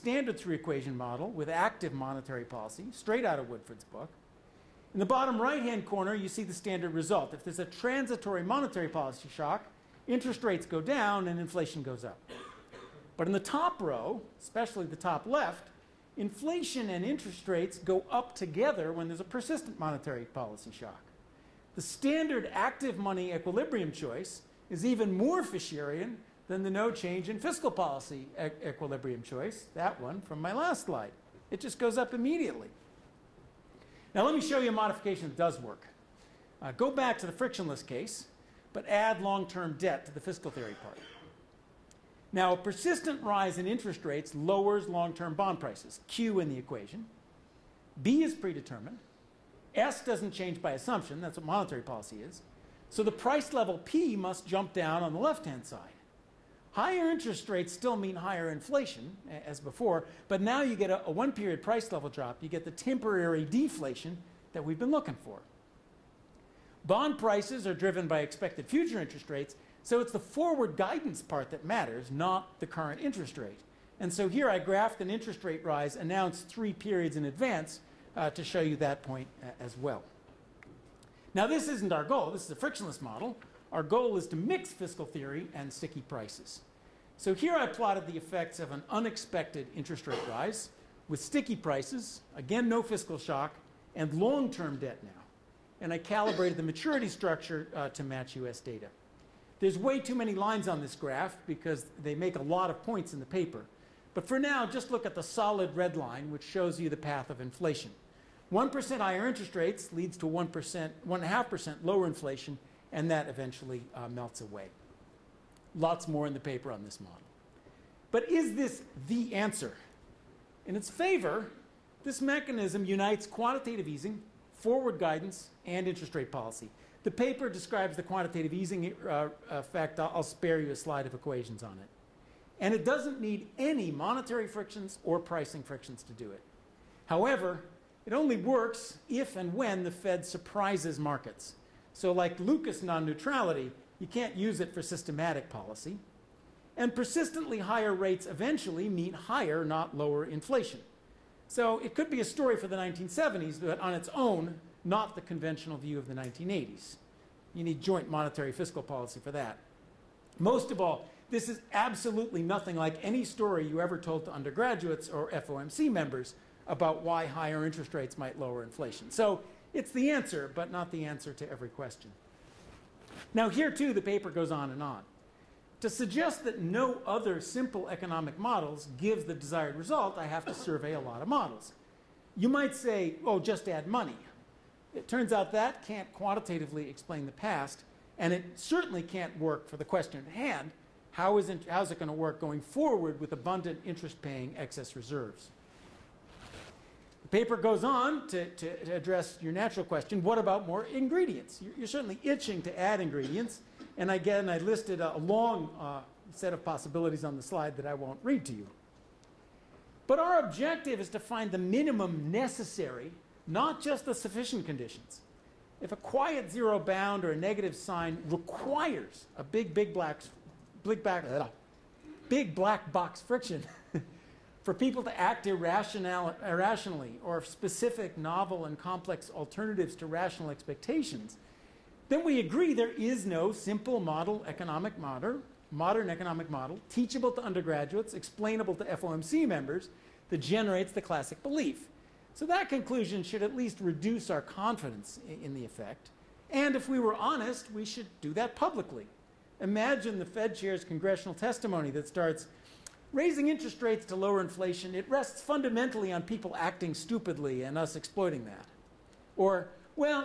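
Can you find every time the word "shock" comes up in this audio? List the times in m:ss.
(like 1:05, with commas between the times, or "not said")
0:09, 0:20, 1:33.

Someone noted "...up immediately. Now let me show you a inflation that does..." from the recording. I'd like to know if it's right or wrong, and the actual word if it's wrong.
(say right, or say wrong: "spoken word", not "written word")
wrong: "modification", not "inflation".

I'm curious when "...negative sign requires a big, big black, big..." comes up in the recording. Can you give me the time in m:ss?
3:37.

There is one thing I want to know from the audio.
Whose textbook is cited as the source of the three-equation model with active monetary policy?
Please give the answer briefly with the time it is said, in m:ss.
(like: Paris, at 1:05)
Woodford, at 0:03.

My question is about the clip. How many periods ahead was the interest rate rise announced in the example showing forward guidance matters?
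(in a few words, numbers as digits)
3.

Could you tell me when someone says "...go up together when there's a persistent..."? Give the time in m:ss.
0:17.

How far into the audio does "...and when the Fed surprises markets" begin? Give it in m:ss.
2:19.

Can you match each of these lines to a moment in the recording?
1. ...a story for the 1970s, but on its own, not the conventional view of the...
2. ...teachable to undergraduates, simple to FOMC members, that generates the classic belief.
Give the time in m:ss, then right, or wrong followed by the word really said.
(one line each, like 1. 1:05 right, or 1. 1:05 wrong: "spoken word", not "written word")
1. 2:32 right
2. 3:56 wrong: "explainable", not "simple".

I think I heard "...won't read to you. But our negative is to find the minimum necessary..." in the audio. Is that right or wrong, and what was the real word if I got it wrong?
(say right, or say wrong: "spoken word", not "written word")
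wrong: "objective", not "negative".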